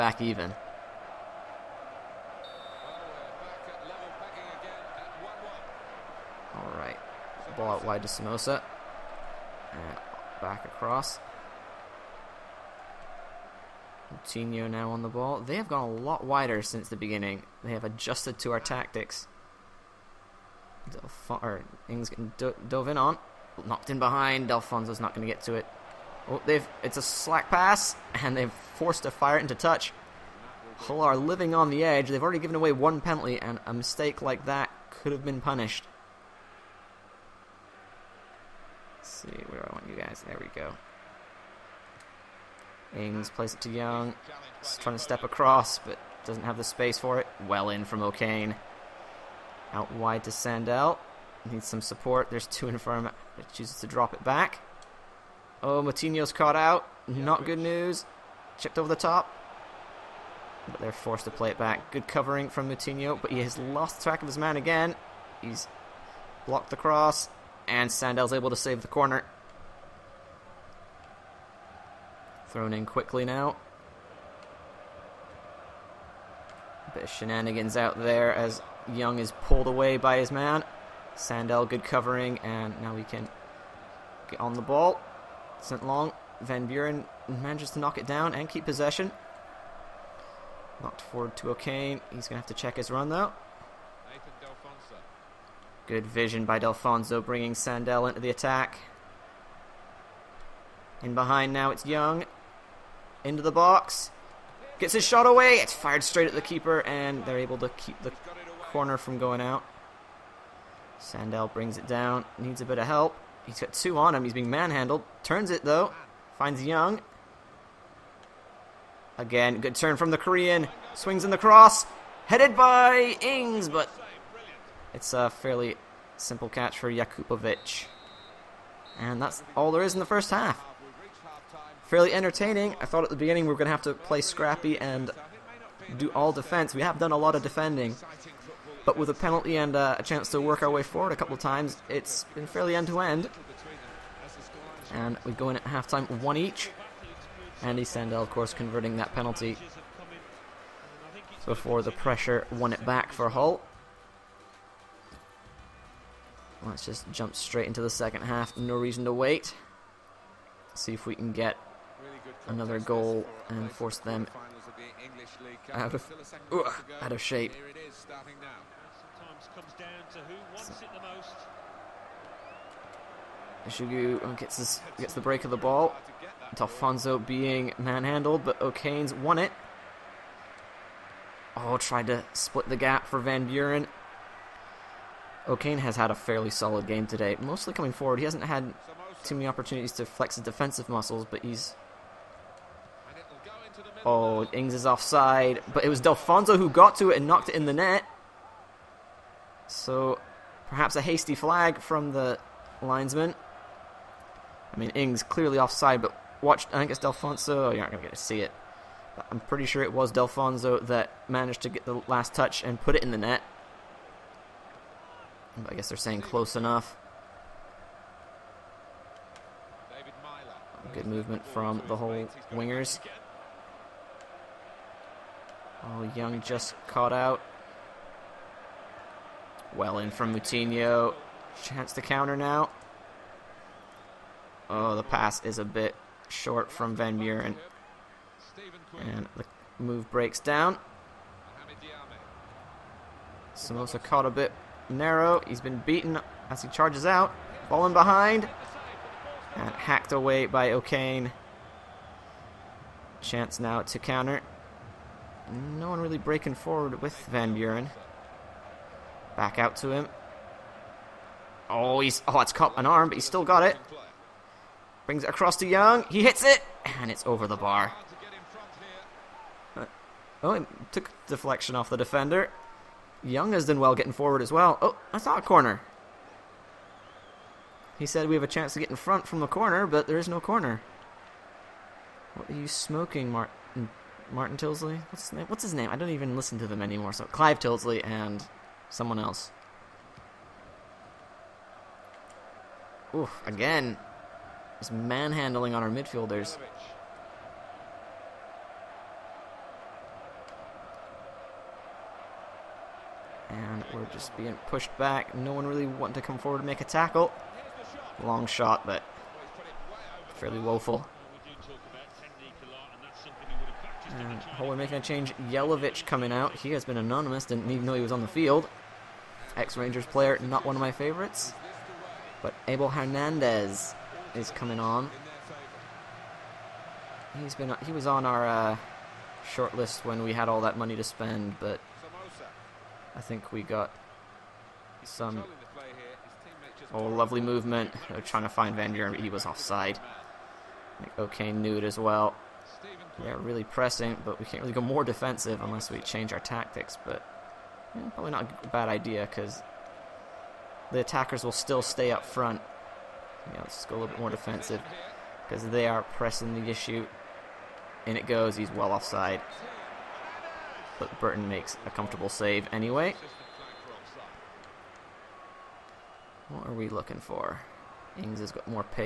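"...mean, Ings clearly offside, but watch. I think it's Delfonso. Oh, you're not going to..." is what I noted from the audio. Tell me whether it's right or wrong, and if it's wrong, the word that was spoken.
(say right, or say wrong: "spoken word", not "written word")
right.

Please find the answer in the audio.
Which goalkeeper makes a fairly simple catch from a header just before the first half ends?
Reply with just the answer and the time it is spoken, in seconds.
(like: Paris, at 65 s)
Jakupovic, at 126 s.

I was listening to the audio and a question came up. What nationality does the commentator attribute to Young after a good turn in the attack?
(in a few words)
Korean.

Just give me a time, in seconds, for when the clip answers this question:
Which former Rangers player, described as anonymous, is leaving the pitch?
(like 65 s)
315 s.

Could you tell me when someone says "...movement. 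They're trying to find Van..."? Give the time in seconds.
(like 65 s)
337 s.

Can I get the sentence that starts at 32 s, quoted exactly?
They've already given away one penalty, and a mistake like that could have been punished.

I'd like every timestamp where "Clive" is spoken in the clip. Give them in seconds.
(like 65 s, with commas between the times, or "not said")
287 s.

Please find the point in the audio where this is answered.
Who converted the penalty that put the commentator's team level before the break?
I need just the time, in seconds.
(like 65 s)
147 s.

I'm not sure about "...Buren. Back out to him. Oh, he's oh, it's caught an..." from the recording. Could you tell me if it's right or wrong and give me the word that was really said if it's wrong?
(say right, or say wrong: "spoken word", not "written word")
right.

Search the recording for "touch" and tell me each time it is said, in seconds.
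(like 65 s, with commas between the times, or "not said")
29 s, 212 s.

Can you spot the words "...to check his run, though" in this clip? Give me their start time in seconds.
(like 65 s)
92 s.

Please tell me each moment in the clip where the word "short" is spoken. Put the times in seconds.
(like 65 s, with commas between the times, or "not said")
236 s, 329 s.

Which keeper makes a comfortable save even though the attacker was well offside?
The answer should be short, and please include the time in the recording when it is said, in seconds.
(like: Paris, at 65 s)
Burton, at 361 s.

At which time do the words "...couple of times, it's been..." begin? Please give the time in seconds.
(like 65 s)
141 s.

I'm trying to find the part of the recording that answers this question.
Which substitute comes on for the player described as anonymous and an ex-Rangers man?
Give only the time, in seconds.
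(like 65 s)
322 s.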